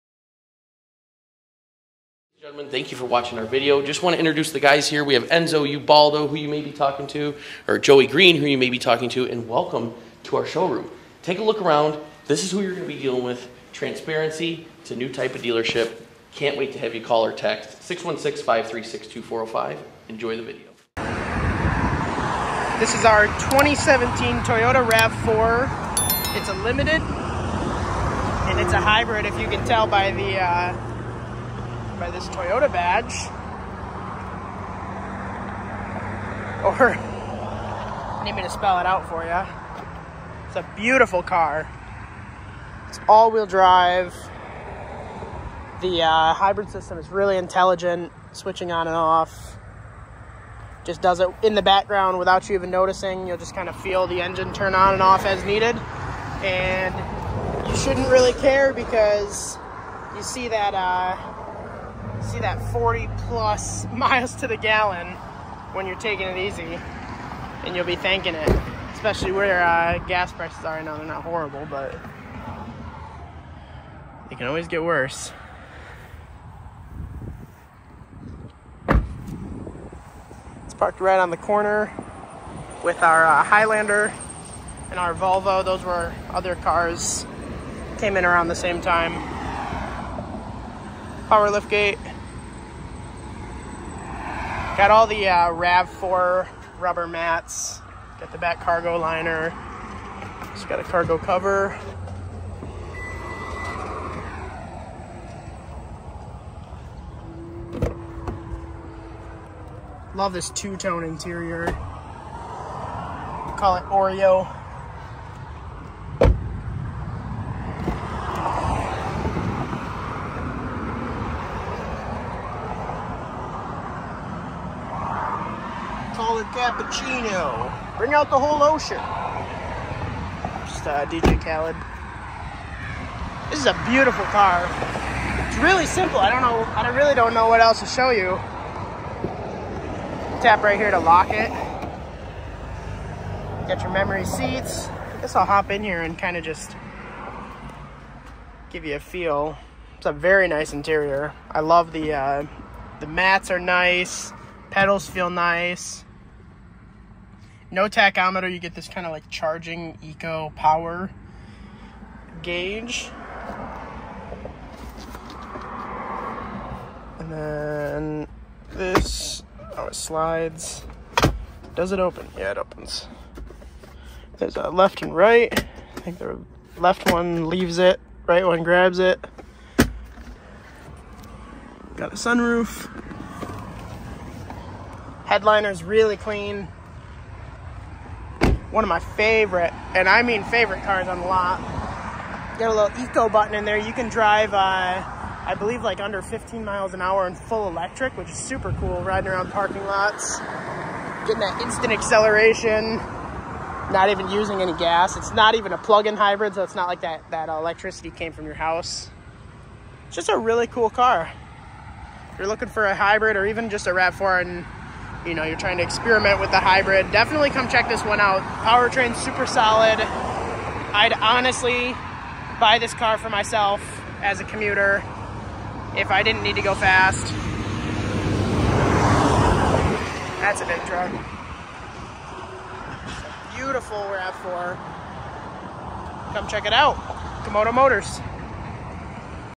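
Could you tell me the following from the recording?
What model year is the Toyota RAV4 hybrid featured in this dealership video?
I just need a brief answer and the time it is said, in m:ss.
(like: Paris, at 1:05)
2017, at 0:23.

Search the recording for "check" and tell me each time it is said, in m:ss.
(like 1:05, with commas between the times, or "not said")
3:37, 3:56.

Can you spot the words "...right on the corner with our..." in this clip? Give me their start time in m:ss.
1:21.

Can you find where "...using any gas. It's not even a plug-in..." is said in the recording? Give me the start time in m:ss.
3:24.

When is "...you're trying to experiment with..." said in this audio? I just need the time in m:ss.
3:35.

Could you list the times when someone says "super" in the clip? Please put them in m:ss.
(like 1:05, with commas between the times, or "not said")
3:18, 3:39.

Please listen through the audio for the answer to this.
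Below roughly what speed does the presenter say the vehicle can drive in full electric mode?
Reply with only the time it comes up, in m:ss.
3:16.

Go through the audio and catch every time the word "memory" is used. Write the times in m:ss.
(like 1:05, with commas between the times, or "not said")
2:23.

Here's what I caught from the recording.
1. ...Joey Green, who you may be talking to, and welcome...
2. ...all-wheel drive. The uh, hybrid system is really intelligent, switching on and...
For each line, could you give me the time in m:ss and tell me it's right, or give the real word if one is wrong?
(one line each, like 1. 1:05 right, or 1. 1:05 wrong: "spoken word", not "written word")
1. 0:07 right
2. 0:43 right.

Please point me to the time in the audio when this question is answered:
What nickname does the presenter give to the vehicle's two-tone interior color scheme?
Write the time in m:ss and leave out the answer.
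1:53.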